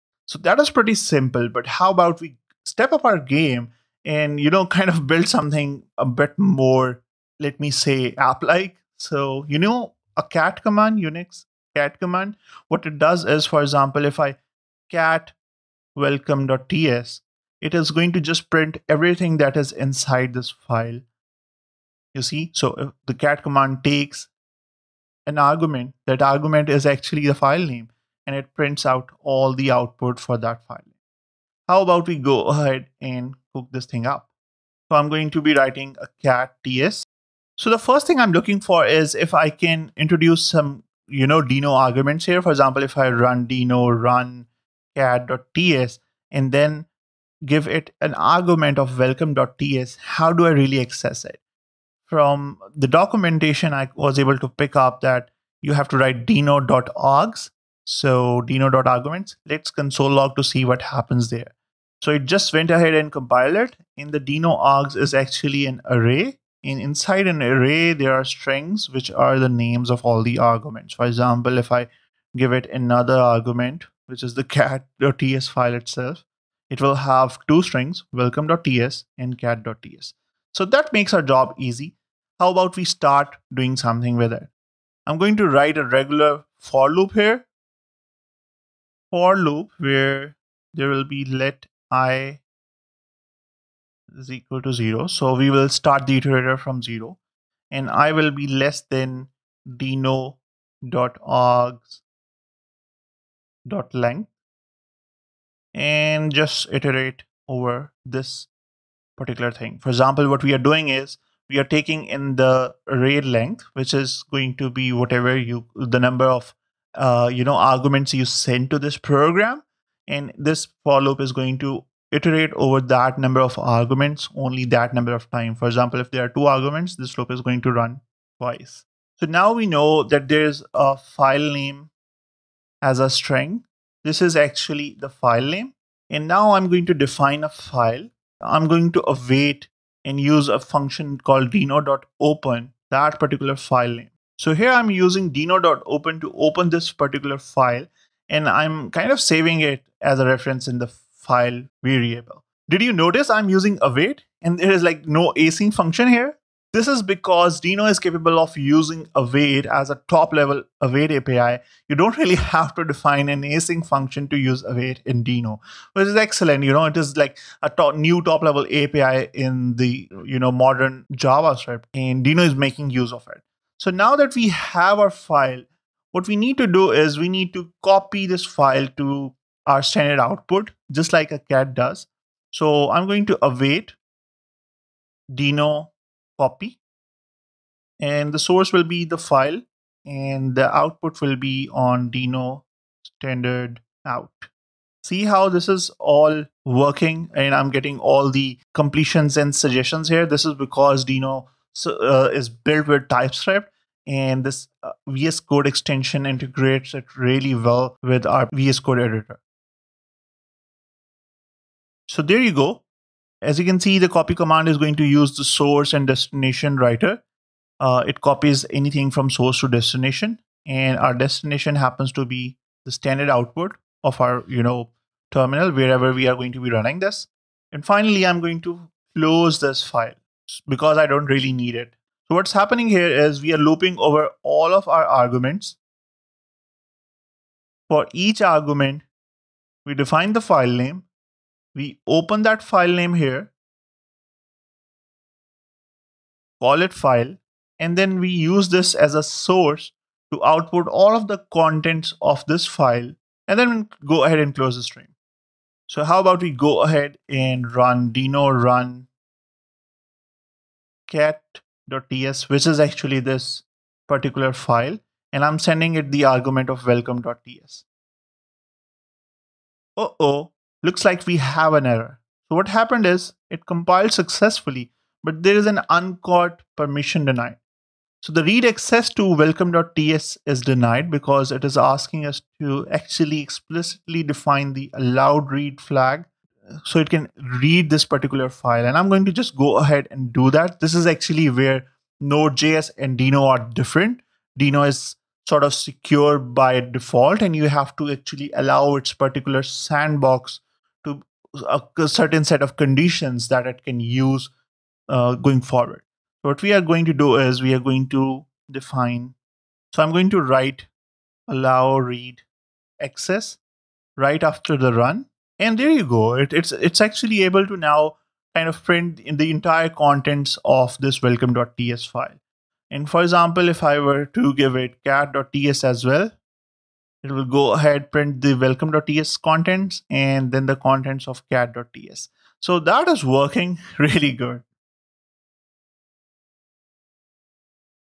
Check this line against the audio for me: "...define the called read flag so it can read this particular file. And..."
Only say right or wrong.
wrong.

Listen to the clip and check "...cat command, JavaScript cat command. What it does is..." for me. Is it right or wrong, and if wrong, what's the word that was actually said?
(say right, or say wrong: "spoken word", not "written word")
wrong: "Unix", not "JavaScript".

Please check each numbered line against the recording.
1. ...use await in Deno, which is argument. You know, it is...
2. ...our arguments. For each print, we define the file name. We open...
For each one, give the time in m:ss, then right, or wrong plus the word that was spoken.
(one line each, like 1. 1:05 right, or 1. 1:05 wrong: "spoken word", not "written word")
1. 2:44 wrong: "excellent", not "argument"
2. 3:54 wrong: "argument", not "print".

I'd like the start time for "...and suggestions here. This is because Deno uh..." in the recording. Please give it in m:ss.
3:19.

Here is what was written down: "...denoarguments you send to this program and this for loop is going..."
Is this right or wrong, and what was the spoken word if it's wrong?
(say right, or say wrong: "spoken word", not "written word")
wrong: "arguments", not "denoarguments".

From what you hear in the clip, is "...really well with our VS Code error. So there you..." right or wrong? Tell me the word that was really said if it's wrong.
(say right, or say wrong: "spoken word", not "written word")
wrong: "editor", not "error".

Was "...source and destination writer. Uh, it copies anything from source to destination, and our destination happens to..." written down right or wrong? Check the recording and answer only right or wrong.
right.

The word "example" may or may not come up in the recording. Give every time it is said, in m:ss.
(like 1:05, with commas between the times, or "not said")
0:13, 0:42, 1:11, 1:49, 2:05, 5:23.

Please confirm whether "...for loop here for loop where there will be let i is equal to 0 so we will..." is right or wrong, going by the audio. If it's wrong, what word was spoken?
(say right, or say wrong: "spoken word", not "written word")
right.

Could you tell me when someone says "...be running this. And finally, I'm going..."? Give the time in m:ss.
3:46.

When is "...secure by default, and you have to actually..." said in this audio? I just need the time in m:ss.
4:55.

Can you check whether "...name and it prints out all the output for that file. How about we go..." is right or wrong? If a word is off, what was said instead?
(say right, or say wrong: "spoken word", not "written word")
right.